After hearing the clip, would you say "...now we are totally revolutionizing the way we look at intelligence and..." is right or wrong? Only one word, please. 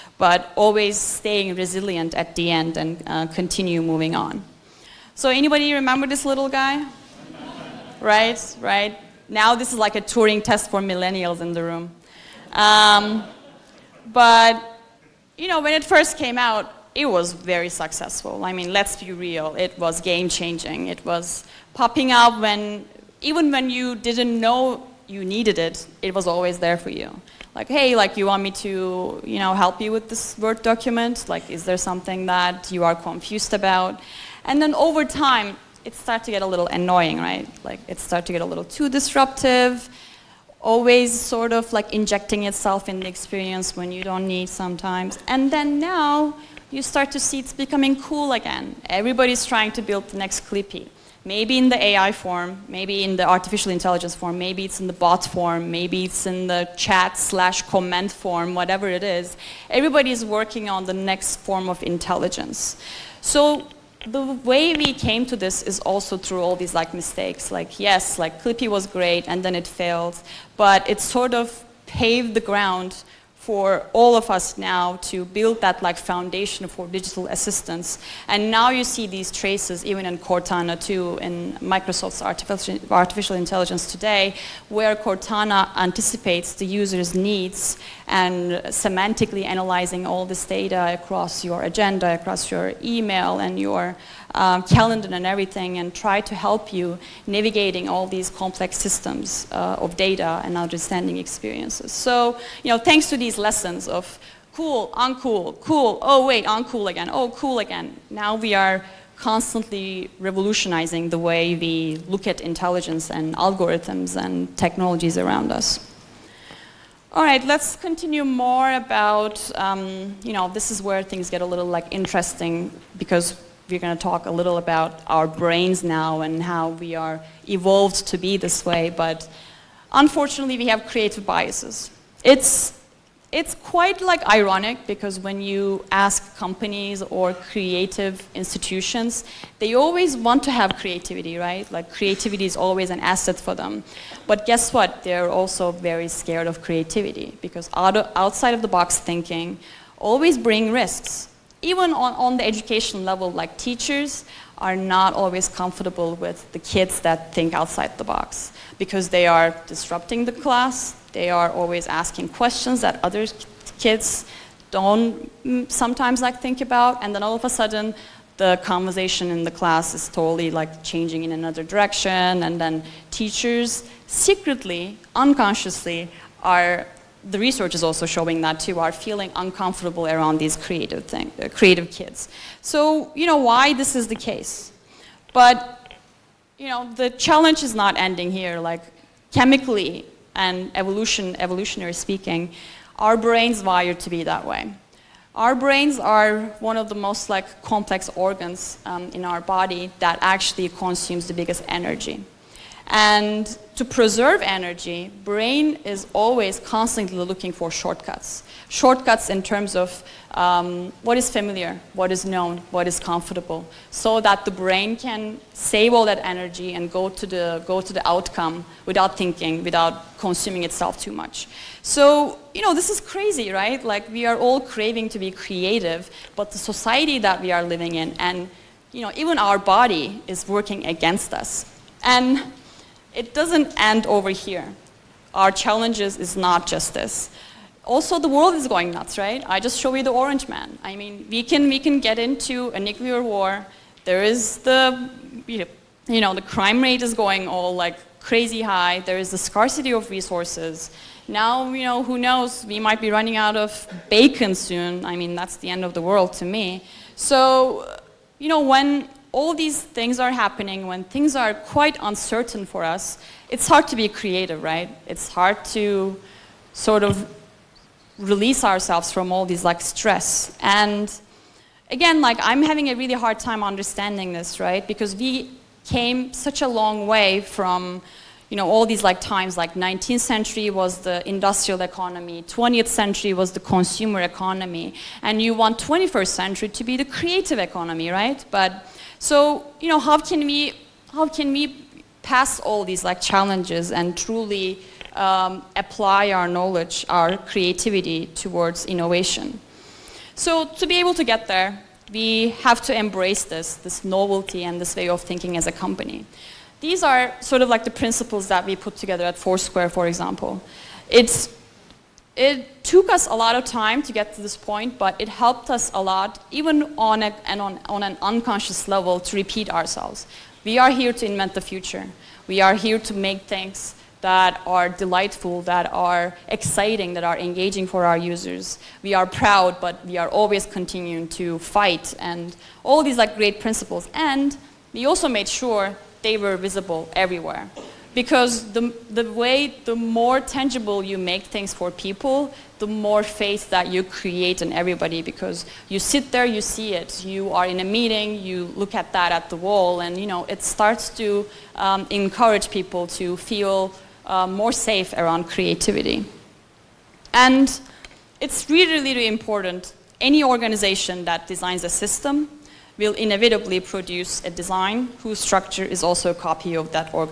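wrong.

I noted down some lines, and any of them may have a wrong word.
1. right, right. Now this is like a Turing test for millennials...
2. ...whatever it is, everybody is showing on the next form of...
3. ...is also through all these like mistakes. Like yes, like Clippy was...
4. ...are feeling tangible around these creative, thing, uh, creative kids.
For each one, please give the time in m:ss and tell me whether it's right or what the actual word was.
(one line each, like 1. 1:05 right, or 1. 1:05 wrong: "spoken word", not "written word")
1. 0:07 right
2. 0:58 wrong: "working", not "showing"
3. 1:05 right
4. 2:58 wrong: "uncomfortable", not "tangible".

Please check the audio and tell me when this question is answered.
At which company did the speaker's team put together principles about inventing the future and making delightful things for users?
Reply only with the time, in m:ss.
5:09.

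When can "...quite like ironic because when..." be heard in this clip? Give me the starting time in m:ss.
2:13.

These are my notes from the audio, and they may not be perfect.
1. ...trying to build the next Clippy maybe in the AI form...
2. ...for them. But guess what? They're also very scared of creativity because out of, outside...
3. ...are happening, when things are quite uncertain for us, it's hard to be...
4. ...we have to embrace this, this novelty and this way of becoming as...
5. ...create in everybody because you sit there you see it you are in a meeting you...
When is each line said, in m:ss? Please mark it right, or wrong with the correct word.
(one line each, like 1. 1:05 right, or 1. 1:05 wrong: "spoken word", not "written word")
1. 0:49 right
2. 2:23 right
3. 4:20 right
4. 5:02 wrong: "thinking", not "becoming"
5. 5:44 right.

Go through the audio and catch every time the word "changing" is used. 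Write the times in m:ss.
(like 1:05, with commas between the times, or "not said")
0:20, 2:50.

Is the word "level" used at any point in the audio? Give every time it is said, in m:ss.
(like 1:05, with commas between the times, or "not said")
2:33, 5:18.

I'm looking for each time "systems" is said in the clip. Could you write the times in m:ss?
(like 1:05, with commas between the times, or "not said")
1:38, 6:01.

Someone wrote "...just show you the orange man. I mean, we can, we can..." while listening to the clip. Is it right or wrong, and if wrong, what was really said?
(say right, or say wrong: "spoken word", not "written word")
right.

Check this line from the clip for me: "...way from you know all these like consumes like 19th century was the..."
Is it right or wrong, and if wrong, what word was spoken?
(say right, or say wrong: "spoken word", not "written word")
wrong: "times", not "consumes".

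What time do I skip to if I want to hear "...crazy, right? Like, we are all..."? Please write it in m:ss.
3:42.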